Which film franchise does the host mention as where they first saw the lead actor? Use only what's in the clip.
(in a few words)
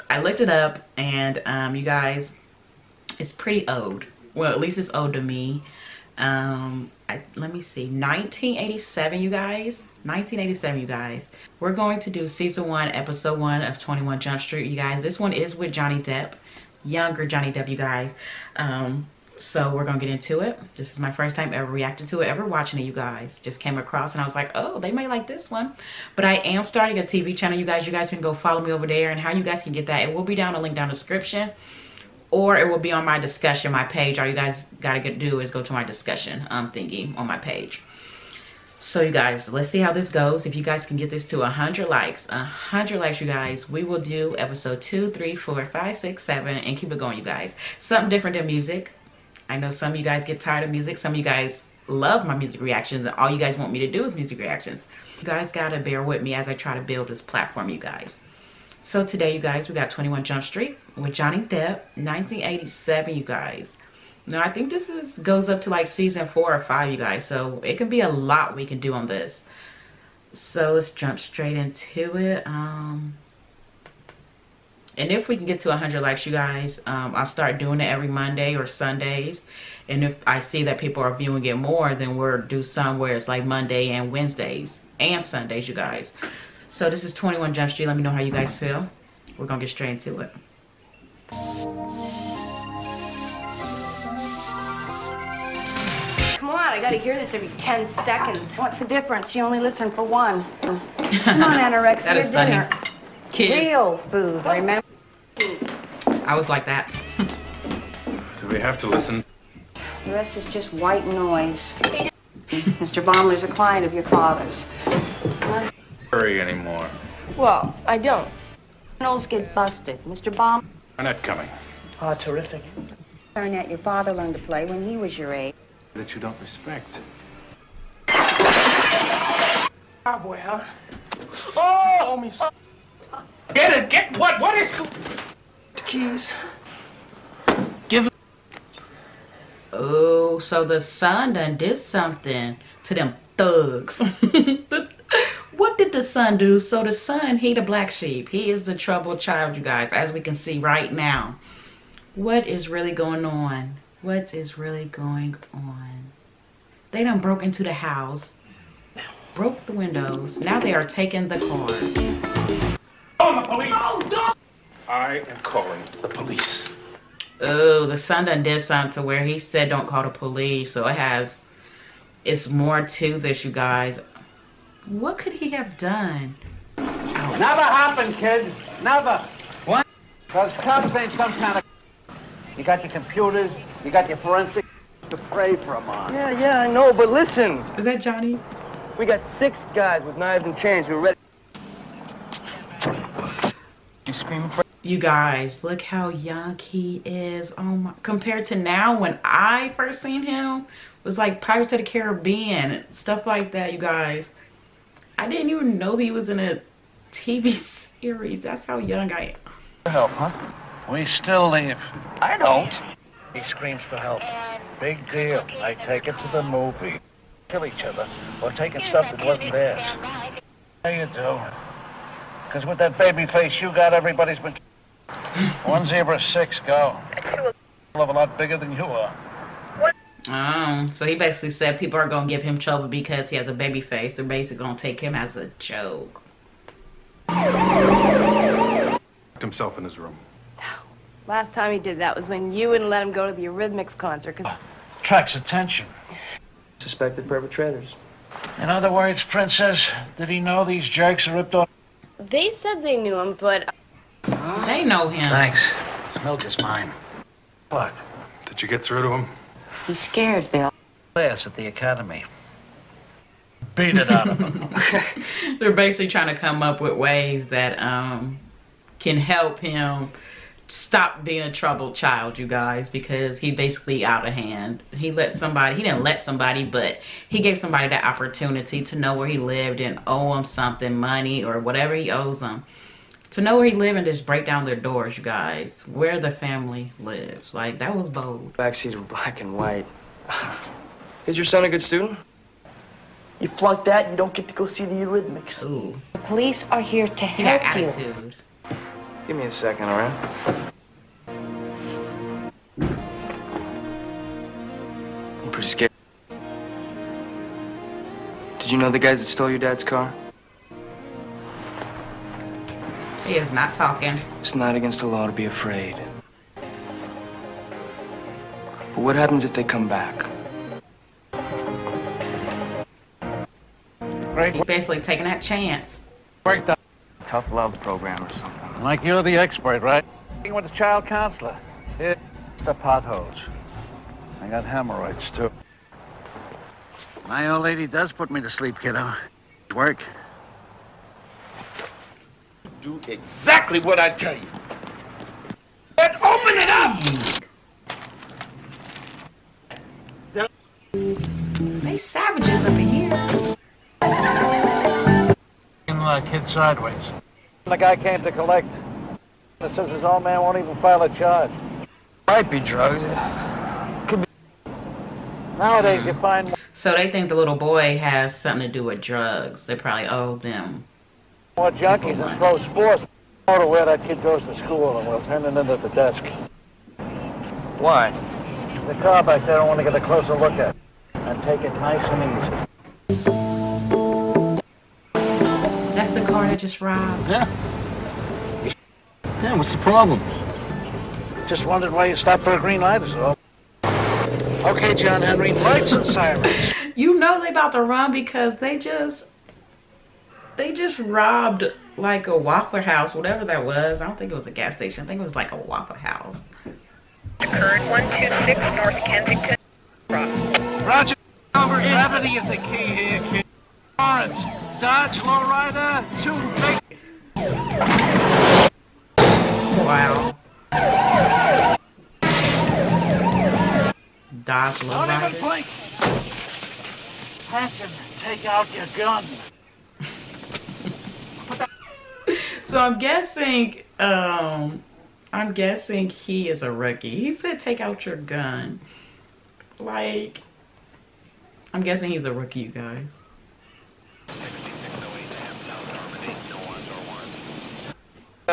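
Pirates of the Caribbean.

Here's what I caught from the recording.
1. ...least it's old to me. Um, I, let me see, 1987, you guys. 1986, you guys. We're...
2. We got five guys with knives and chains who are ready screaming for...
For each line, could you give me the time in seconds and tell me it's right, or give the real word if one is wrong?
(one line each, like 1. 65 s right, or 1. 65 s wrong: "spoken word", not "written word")
1. 4 s wrong: "1987", not "1986"
2. 188 s wrong: "six", not "five".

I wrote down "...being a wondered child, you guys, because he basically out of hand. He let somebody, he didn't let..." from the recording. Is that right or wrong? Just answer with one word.
wrong.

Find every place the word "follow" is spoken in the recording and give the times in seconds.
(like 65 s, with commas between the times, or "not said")
28 s.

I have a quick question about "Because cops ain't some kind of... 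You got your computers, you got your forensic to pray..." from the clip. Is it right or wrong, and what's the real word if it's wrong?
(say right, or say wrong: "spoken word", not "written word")
right.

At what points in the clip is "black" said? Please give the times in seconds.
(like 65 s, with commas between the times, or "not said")
147 s, 289 s.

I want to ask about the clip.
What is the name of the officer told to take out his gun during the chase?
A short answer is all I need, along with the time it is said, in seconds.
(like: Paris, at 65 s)
Hanson, at 427 s.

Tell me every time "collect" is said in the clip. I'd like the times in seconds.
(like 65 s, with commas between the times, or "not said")
358 s.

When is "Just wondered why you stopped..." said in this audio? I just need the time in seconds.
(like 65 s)
391 s.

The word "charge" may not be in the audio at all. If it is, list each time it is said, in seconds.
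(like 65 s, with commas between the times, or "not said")
361 s.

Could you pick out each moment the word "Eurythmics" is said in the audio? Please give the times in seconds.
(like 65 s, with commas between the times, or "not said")
243 s, 294 s.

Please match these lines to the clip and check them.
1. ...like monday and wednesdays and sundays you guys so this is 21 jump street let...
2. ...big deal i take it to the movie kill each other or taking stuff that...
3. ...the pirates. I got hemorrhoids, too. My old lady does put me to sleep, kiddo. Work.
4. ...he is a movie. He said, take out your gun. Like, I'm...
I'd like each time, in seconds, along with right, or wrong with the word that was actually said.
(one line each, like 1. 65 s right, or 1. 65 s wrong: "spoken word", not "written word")
1. 83 s right
2. 214 s right
3. 332 s wrong: "potholes", not "pirates"
4. 436 s wrong: "rookie", not "movie".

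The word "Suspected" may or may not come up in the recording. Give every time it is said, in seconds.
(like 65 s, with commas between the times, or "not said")
246 s.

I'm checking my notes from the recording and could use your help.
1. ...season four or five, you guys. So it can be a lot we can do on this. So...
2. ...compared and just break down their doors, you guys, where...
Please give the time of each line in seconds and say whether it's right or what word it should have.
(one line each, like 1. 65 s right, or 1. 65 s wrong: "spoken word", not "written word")
1. 65 s right
2. 283 s wrong: "lived", not "compared".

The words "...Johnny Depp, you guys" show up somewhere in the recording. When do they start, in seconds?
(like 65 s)
17 s.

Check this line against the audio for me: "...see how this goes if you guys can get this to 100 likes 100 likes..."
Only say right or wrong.
right.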